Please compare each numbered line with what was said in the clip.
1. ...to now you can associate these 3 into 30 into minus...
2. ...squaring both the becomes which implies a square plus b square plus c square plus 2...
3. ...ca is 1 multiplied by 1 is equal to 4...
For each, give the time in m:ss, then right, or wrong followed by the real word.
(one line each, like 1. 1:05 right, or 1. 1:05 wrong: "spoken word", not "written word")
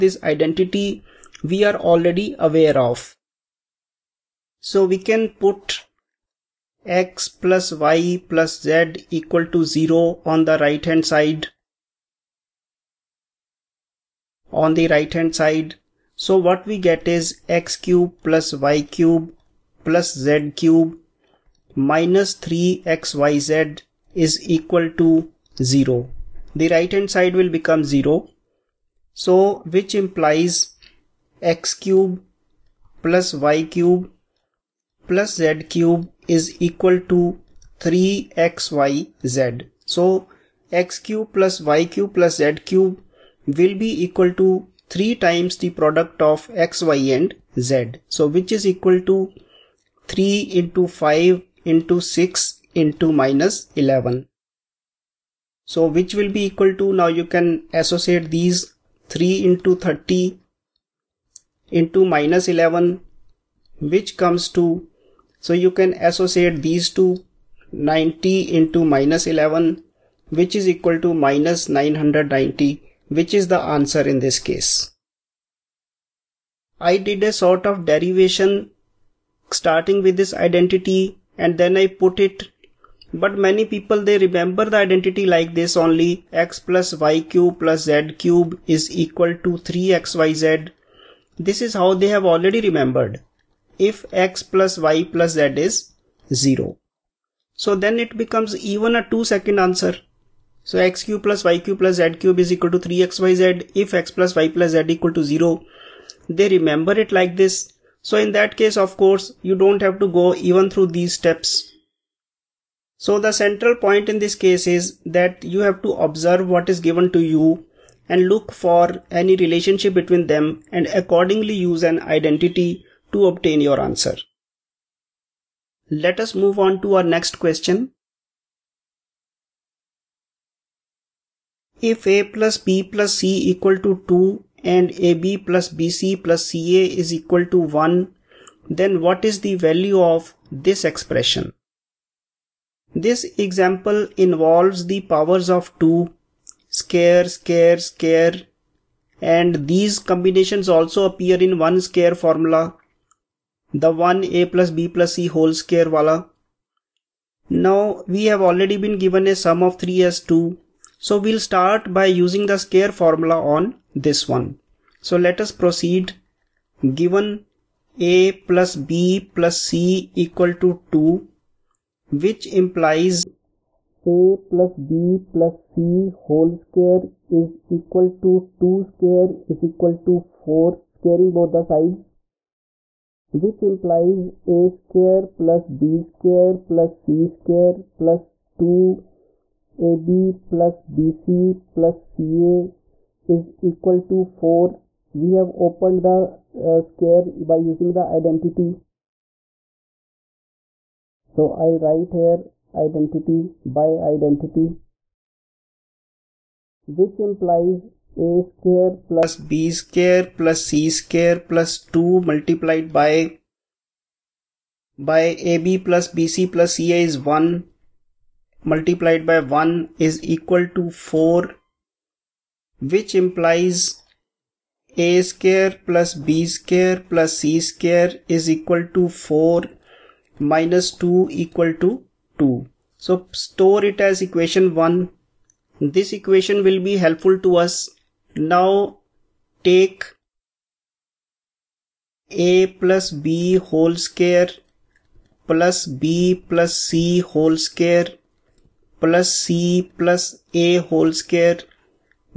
1. 0:56 right
2. 3:00 wrong: "sides", not "becomes"
3. 3:36 right.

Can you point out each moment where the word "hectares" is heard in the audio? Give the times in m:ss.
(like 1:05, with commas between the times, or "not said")
not said.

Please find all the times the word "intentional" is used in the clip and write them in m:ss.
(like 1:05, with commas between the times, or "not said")
not said.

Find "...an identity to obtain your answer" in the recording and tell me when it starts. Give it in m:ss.
2:01.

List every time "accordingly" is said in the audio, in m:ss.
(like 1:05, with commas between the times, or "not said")
2:00.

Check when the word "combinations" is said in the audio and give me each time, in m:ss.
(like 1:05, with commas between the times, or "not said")
2:29.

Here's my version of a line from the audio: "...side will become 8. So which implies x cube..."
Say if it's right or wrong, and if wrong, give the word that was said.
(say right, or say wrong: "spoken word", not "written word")
wrong: "0", not "8".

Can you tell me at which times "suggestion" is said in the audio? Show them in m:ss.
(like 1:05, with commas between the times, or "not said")
not said.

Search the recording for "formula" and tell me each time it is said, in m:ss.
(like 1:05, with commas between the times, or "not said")
2:32, 2:42.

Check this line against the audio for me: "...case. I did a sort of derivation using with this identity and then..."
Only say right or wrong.
wrong.